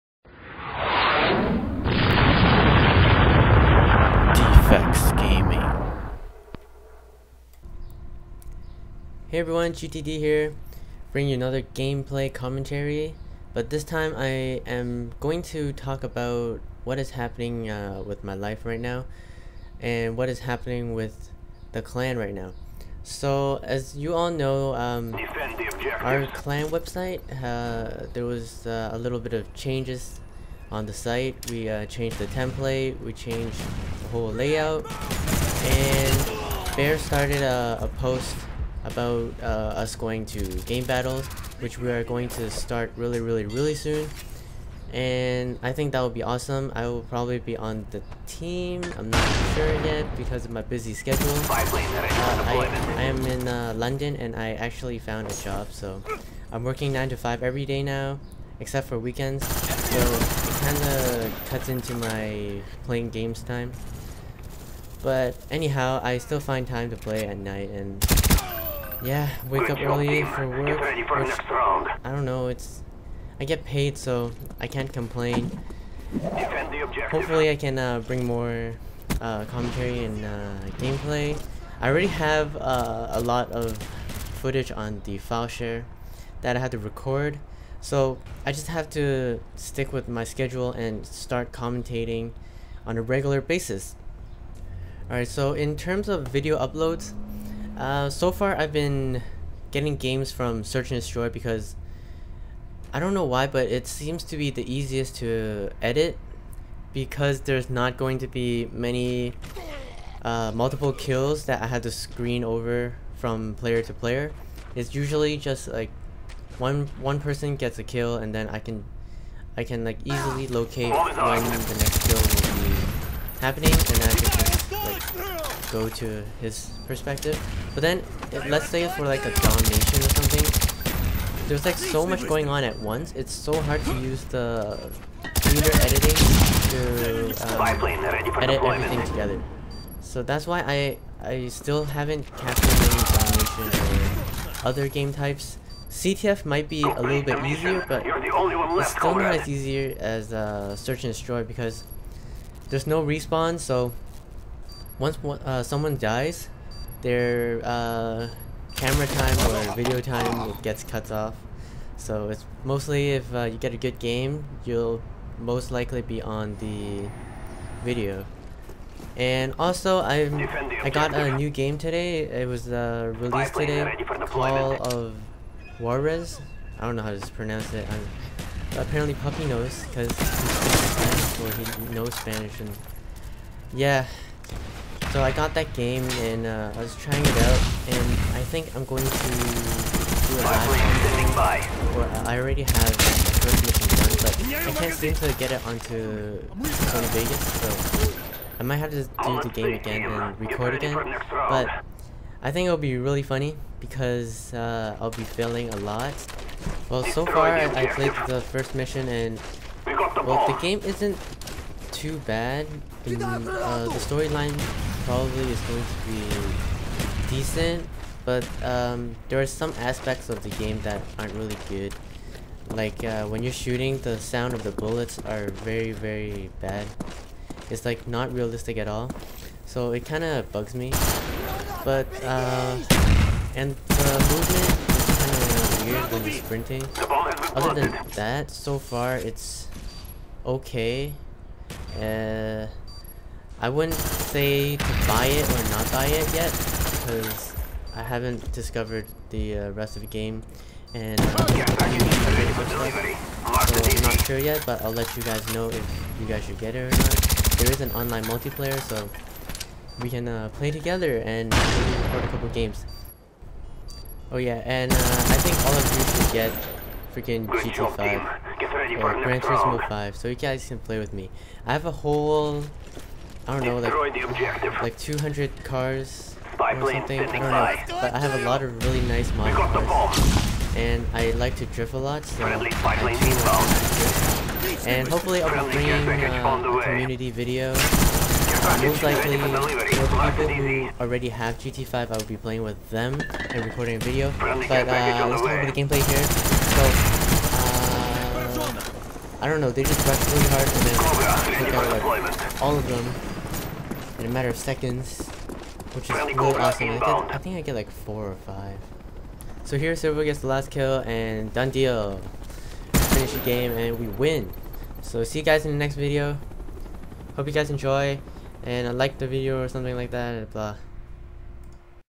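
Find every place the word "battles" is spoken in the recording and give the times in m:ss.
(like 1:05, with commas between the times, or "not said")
0:40.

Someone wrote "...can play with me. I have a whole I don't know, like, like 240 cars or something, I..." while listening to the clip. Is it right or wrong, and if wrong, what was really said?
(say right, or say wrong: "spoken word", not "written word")
wrong: "200", not "240".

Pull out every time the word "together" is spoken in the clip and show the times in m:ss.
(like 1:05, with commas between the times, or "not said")
2:19, 4:20.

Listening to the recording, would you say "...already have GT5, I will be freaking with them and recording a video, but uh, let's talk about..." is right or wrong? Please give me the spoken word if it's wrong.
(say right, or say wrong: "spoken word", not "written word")
wrong: "playing", not "freaking".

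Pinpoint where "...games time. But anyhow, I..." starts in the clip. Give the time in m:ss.
1:03.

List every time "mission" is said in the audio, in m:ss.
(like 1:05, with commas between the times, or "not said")
3:13, 3:28.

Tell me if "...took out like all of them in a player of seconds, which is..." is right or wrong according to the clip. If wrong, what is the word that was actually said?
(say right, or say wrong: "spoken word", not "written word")
wrong: "matter", not "player".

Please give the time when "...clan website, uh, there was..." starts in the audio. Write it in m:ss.
0:26.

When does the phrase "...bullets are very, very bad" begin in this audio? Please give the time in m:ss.
3:44.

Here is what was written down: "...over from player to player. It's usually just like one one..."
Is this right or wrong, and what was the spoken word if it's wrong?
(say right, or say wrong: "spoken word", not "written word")
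right.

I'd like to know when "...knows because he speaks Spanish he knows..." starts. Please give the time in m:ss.
2:59.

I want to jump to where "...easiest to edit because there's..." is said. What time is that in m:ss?
1:44.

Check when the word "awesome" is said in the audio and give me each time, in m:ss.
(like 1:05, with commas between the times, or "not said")
0:46, 5:06.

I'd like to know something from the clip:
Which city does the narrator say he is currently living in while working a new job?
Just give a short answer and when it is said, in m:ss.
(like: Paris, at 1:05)
London, at 0:53.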